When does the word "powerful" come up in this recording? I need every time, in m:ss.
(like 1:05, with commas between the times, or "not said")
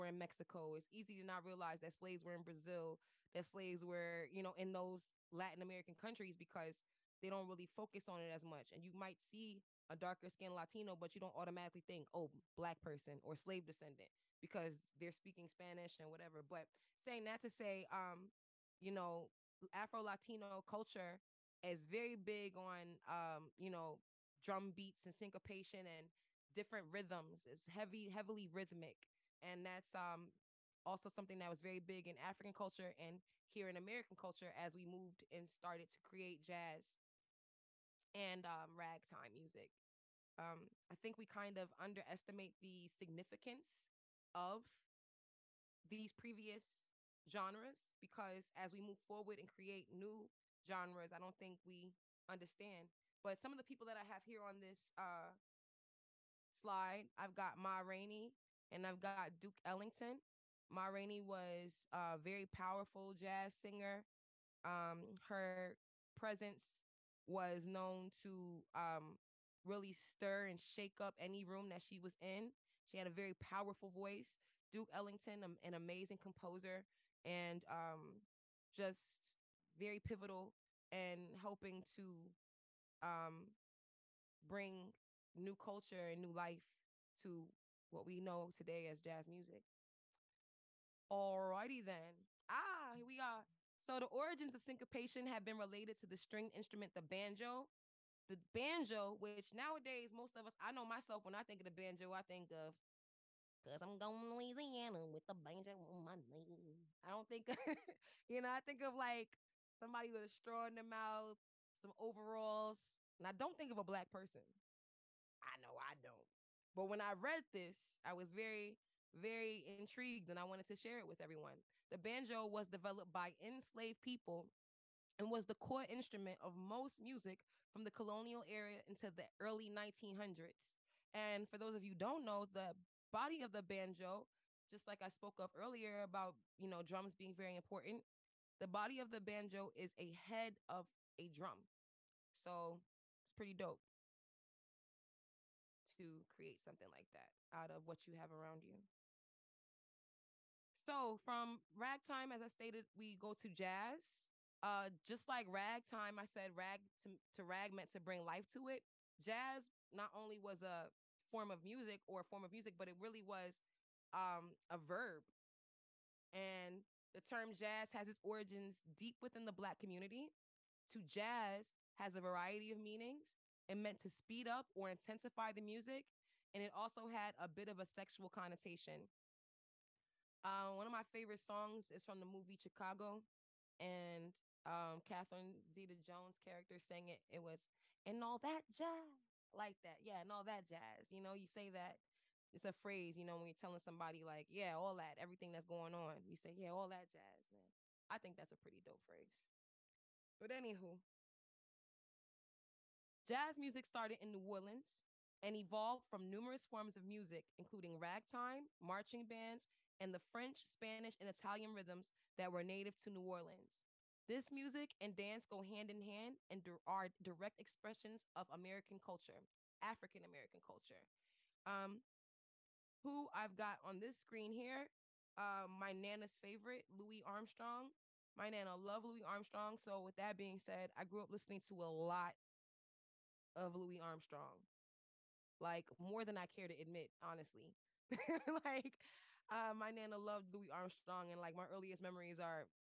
1:02, 1:13.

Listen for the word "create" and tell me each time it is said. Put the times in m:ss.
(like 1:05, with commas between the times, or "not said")
0:36, 0:49, 2:26.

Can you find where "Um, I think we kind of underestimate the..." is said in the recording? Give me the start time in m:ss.
0:40.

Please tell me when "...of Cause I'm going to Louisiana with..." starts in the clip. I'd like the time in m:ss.
1:42.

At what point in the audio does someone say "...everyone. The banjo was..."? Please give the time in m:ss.
2:01.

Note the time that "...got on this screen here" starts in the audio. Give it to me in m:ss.
3:43.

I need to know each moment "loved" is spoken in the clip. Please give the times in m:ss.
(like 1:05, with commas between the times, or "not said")
3:48, 4:00.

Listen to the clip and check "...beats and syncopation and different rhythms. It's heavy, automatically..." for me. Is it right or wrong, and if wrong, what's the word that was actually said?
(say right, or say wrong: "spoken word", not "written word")
wrong: "heavily", not "automatically".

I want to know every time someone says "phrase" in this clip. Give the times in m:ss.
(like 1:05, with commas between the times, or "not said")
3:12, 3:19.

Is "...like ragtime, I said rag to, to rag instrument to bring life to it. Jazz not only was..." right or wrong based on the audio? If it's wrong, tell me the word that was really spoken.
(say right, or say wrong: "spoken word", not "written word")
wrong: "meant", not "instrument".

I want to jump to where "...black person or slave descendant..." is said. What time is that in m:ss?
0:12.